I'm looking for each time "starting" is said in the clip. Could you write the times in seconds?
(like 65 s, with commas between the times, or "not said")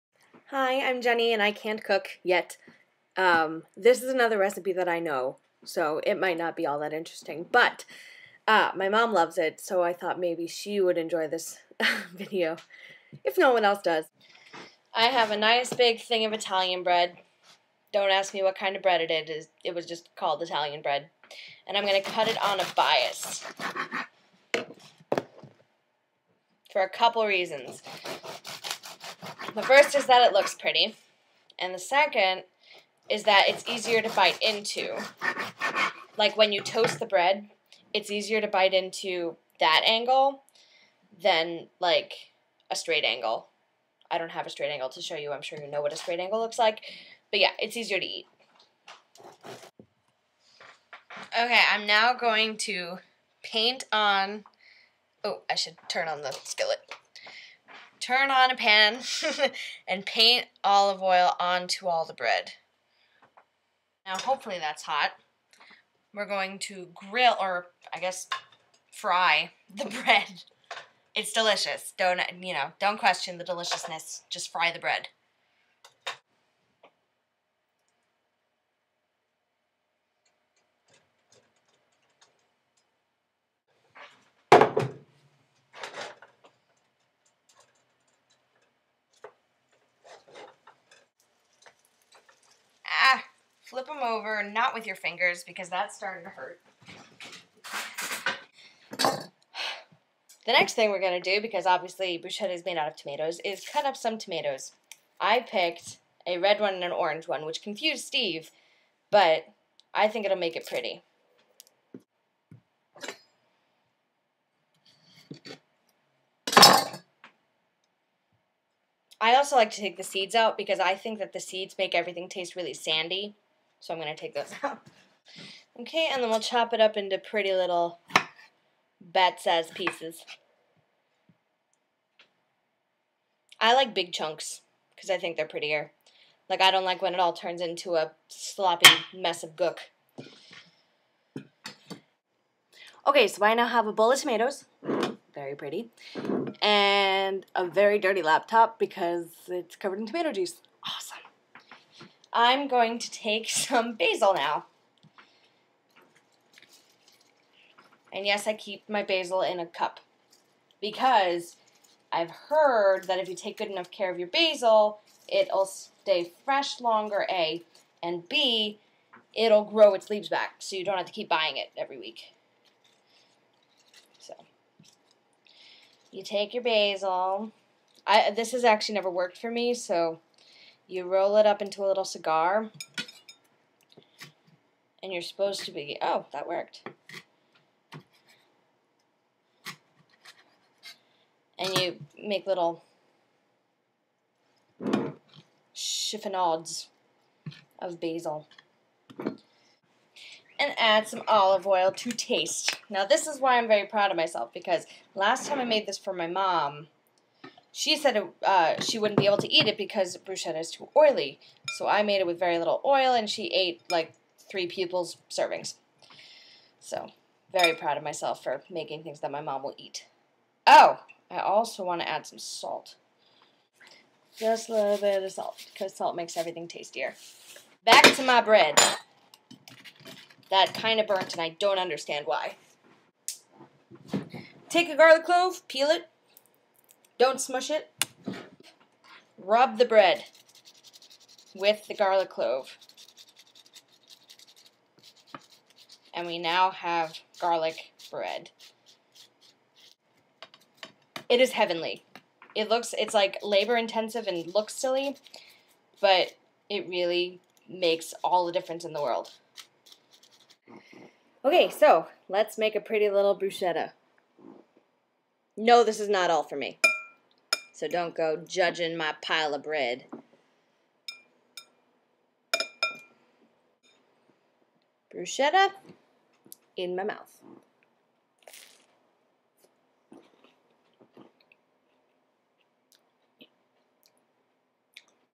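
95 s.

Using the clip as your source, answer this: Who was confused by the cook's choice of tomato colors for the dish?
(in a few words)
Steve.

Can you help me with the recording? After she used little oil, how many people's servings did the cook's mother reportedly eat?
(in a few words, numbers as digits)
3.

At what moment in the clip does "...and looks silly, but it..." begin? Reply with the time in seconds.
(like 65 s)
254 s.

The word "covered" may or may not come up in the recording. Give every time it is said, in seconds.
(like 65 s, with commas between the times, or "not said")
149 s.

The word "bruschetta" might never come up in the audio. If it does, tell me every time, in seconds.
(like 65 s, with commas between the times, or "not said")
102 s, 210 s, 263 s, 275 s.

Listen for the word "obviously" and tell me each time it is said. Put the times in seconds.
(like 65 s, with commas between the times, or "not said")
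101 s.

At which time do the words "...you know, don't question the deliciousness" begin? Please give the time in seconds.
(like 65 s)
72 s.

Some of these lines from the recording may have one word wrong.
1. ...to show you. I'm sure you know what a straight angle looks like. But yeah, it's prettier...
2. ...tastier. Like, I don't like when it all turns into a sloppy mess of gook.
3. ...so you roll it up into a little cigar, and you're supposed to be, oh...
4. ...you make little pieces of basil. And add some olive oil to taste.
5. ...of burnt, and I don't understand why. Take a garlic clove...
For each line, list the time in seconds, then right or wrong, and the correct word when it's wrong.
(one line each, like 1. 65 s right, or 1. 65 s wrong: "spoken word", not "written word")
1. 44 s wrong: "easier", not "prettier"
2. 135 s wrong: "prettier", not "tastier"
3. 179 s right
4. 191 s wrong: "chiffonades", not "pieces"
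5. 230 s right.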